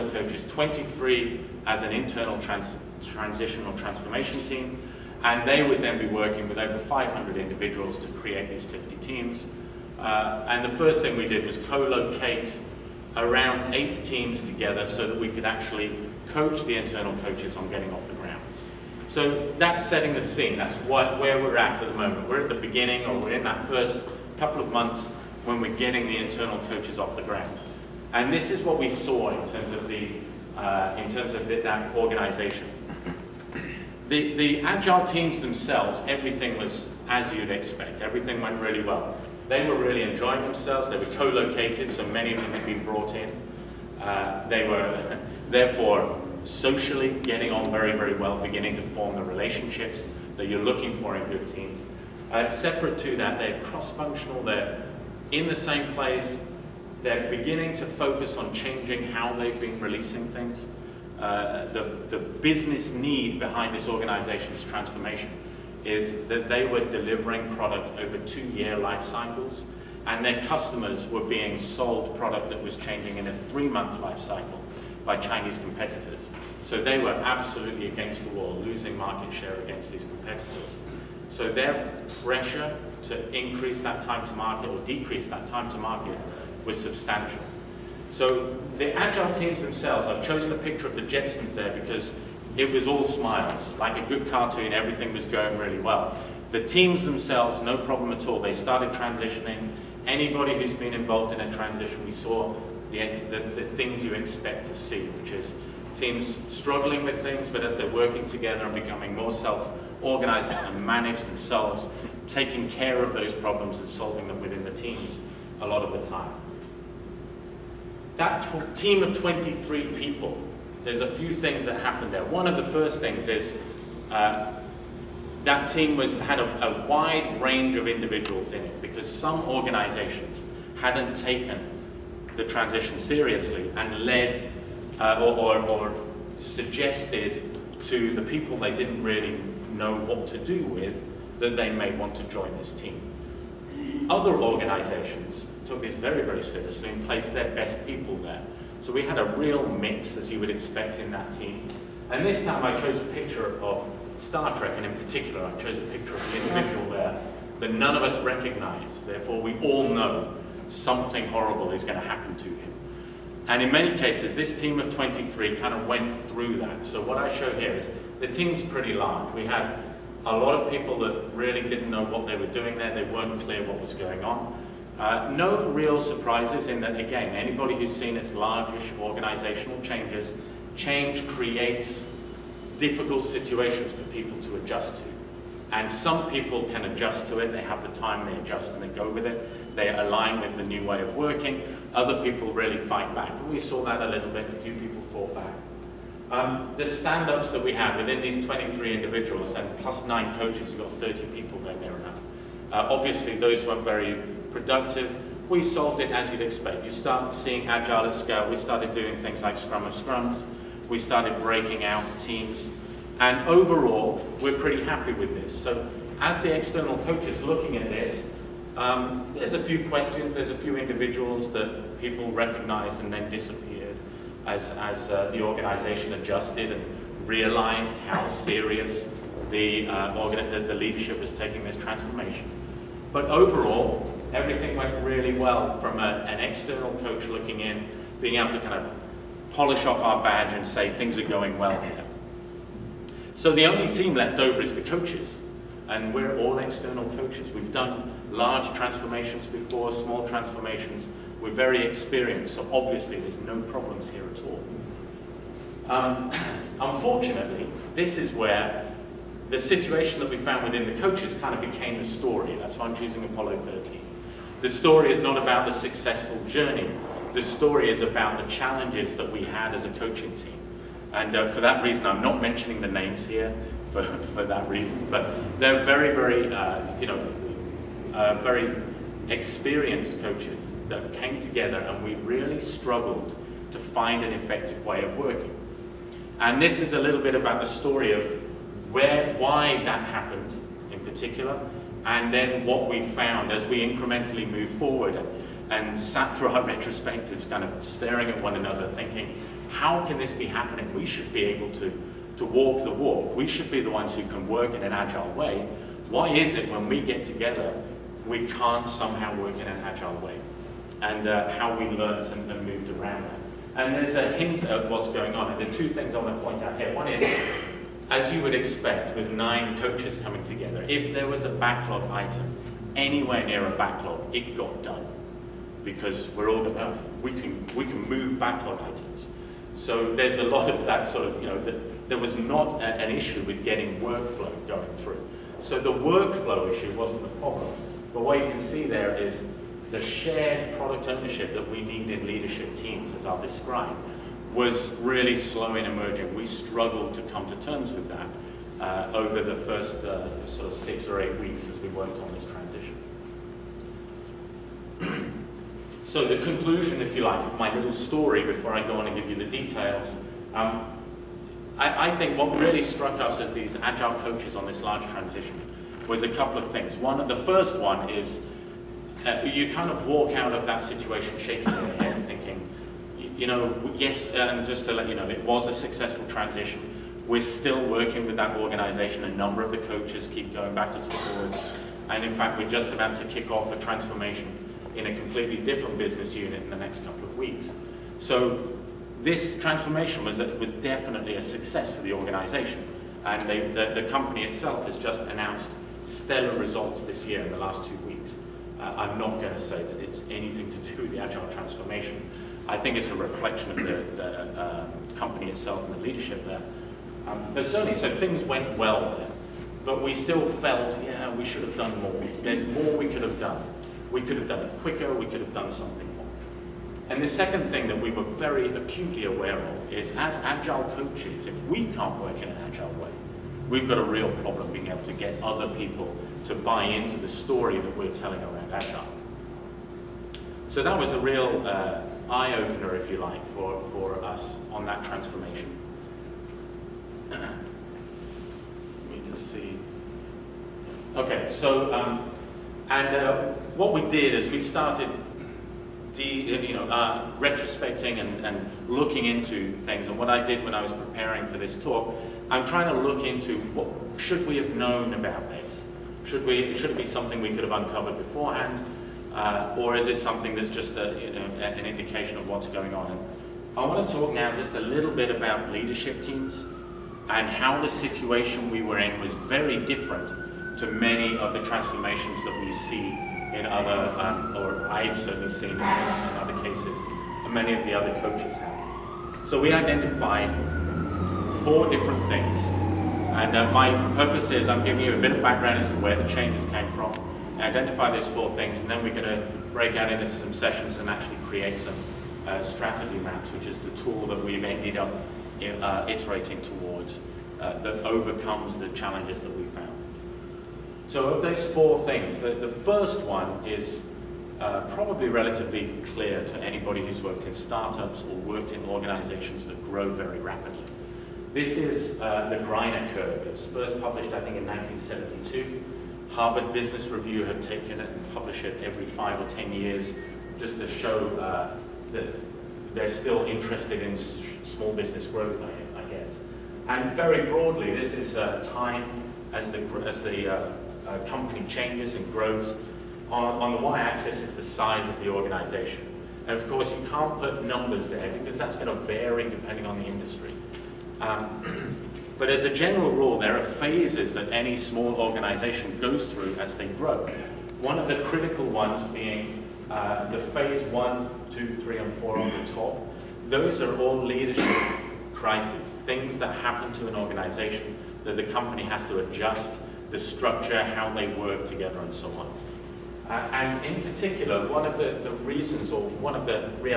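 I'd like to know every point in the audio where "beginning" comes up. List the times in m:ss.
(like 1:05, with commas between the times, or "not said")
0:22, 0:48, 0:57.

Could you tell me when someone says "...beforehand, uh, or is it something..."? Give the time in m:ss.
7:38.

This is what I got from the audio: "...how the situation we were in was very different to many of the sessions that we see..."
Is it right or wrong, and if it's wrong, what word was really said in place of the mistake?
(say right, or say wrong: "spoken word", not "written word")
wrong: "transformations", not "sessions".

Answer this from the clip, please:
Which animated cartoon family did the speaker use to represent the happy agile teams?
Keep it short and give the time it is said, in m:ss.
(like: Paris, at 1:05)
The Jetsons, at 1:30.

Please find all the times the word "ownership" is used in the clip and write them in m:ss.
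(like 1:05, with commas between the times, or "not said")
5:41.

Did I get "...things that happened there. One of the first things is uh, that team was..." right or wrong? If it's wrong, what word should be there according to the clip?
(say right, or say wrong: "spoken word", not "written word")
right.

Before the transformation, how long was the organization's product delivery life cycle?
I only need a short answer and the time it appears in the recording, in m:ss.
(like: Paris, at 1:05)
2 years, at 1:08.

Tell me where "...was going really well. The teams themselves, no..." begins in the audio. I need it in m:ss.
1:35.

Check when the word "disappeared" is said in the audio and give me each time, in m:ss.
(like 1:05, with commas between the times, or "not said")
3:43.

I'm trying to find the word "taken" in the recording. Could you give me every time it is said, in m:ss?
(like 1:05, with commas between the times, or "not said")
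2:11, 8:37.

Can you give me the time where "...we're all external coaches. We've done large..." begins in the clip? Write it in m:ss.
4:06.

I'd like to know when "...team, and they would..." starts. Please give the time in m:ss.
0:04.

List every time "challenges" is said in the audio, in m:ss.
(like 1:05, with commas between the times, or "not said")
4:28, 8:18.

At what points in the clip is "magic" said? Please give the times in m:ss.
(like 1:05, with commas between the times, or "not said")
not said.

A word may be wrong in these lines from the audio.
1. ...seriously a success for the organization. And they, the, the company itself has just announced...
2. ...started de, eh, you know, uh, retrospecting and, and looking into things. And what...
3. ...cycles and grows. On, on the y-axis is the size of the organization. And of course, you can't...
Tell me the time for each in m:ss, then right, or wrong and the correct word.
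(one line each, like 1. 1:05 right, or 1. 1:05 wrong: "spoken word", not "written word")
1. 6:30 wrong: "definitely", not "seriously"
2. 7:24 right
3. 8:51 wrong: "changes", not "cycles".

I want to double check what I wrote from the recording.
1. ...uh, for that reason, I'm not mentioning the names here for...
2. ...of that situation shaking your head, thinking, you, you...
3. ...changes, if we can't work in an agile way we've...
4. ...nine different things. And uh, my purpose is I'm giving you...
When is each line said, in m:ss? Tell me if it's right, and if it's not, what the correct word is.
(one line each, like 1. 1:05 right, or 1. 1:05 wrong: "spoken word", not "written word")
1. 4:31 right
2. 6:10 right
3. 7:00 wrong: "coaches", not "changes"
4. 8:01 wrong: "four", not "nine".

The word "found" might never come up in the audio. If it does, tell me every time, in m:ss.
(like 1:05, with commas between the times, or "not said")
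4:20, 4:53.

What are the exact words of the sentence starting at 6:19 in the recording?
A number of the coaches keep going backwards and forwards.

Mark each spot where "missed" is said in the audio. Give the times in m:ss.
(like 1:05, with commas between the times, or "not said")
not said.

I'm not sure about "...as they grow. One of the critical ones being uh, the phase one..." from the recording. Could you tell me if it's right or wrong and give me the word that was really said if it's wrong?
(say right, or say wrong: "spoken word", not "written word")
right.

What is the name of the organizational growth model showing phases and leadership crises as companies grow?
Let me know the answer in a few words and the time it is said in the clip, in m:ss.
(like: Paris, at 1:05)
Greiner curve, at 8:32.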